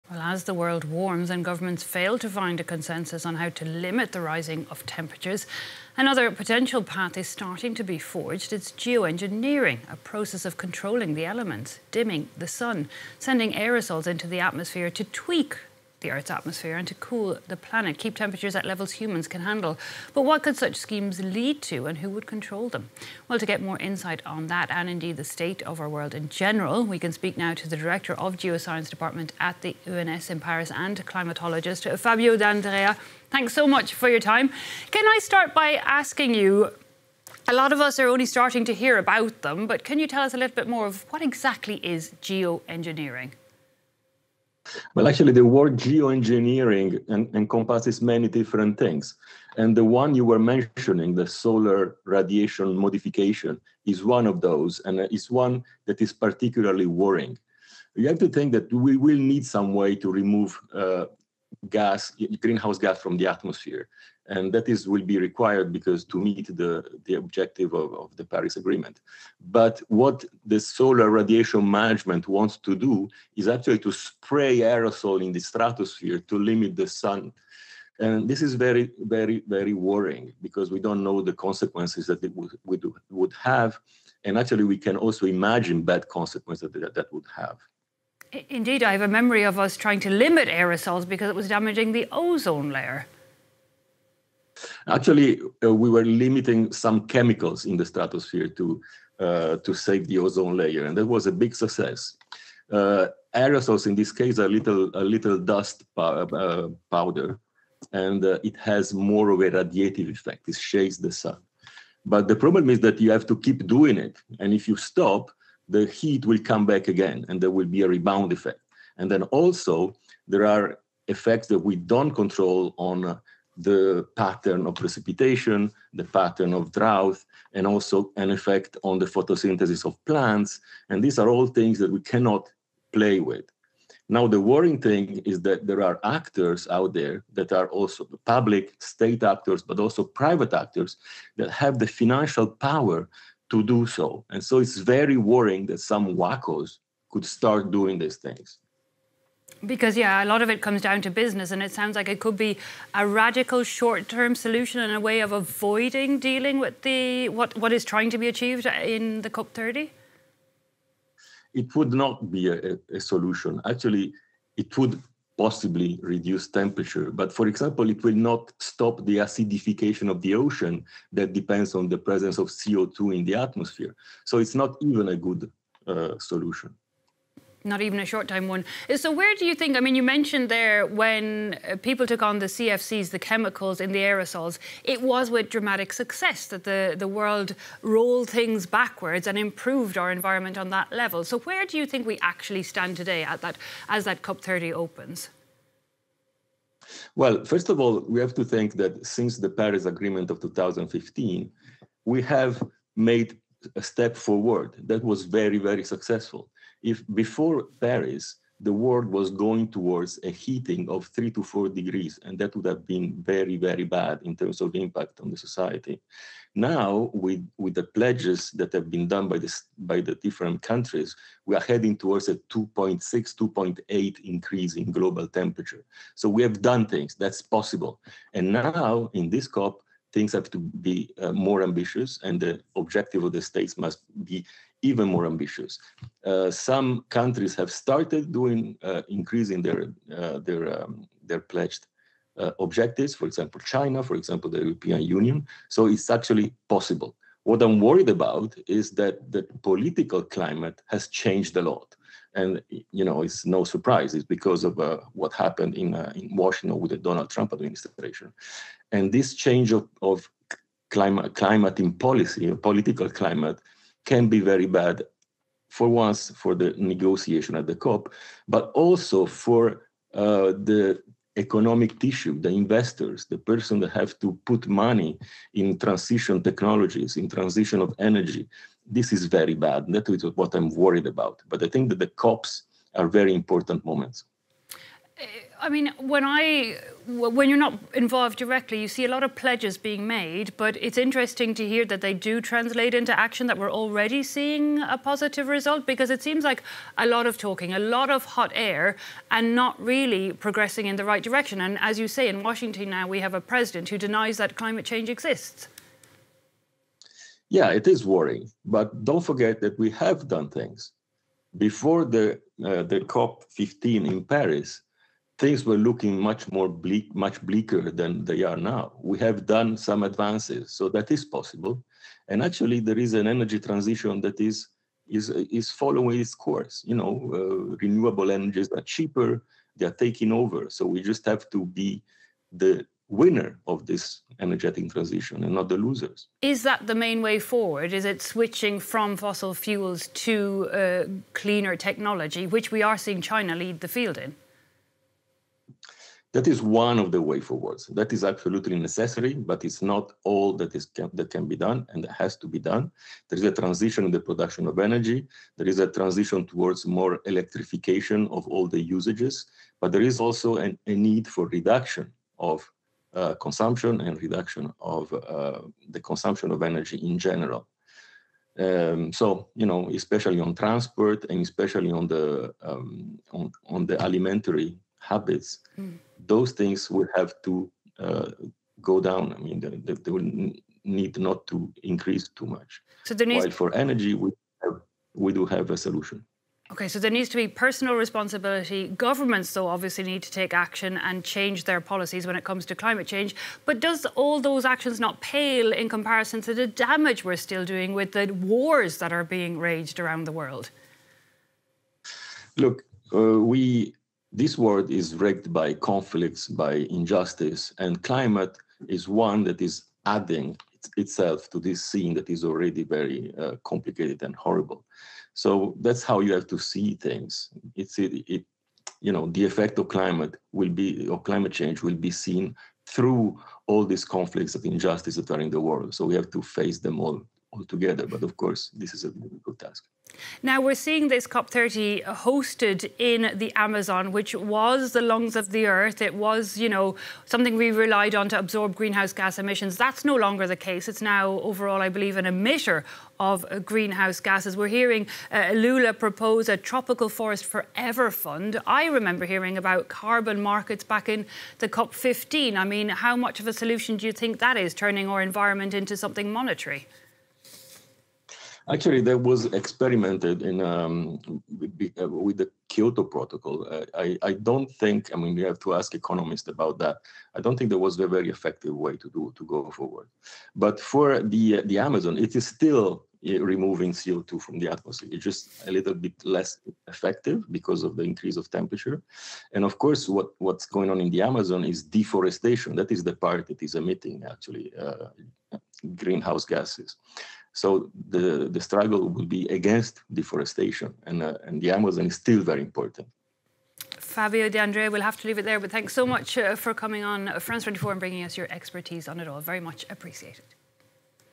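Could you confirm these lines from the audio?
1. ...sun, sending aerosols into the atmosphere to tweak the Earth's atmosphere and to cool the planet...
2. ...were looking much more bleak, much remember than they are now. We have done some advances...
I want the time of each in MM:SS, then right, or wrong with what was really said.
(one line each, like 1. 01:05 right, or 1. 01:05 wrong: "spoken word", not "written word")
1. 00:12 right
2. 05:15 wrong: "bleaker", not "remember".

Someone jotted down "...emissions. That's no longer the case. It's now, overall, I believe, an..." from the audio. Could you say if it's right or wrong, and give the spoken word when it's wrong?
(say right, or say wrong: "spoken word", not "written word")
right.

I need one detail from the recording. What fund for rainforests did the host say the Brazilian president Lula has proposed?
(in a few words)
tropical forest forever fund.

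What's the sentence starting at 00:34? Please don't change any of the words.
Can I start by asking you?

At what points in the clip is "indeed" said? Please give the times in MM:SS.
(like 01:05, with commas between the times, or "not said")
00:24, 01:28.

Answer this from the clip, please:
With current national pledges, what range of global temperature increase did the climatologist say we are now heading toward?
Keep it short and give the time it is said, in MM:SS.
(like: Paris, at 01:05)
2.6 to 2.8, at 03:42.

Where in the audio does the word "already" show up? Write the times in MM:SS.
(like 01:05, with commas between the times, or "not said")
04:53, 06:52.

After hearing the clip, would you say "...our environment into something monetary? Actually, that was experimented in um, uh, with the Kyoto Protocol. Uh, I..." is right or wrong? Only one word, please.
right.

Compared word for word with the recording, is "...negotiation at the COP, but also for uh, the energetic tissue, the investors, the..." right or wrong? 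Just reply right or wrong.
wrong.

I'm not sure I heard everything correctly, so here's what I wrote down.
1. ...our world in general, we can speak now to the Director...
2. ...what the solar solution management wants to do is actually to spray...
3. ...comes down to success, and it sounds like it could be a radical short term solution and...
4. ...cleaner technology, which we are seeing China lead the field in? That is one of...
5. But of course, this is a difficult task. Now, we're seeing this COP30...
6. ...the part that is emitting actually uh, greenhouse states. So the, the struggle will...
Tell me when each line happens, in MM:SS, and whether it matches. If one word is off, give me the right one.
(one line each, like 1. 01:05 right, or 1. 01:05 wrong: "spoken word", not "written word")
1. 00:25 right
2. 01:09 wrong: "radiation", not "solution"
3. 02:30 wrong: "business", not "success"
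4. 05:41 right
5. 07:08 right
6. 08:03 wrong: "gases", not "states".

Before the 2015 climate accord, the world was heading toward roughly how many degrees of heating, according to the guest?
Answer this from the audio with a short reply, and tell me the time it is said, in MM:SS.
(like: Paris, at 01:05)
3 to 4 degrees, at 03:31.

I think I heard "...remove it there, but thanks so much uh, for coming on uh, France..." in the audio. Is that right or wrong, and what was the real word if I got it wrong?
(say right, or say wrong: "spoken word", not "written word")
wrong: "leave", not "remove".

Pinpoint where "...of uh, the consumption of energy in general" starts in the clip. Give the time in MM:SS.
06:04.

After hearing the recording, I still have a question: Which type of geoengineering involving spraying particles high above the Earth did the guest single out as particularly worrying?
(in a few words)
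solar radiation modification.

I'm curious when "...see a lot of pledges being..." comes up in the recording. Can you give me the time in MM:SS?
04:48.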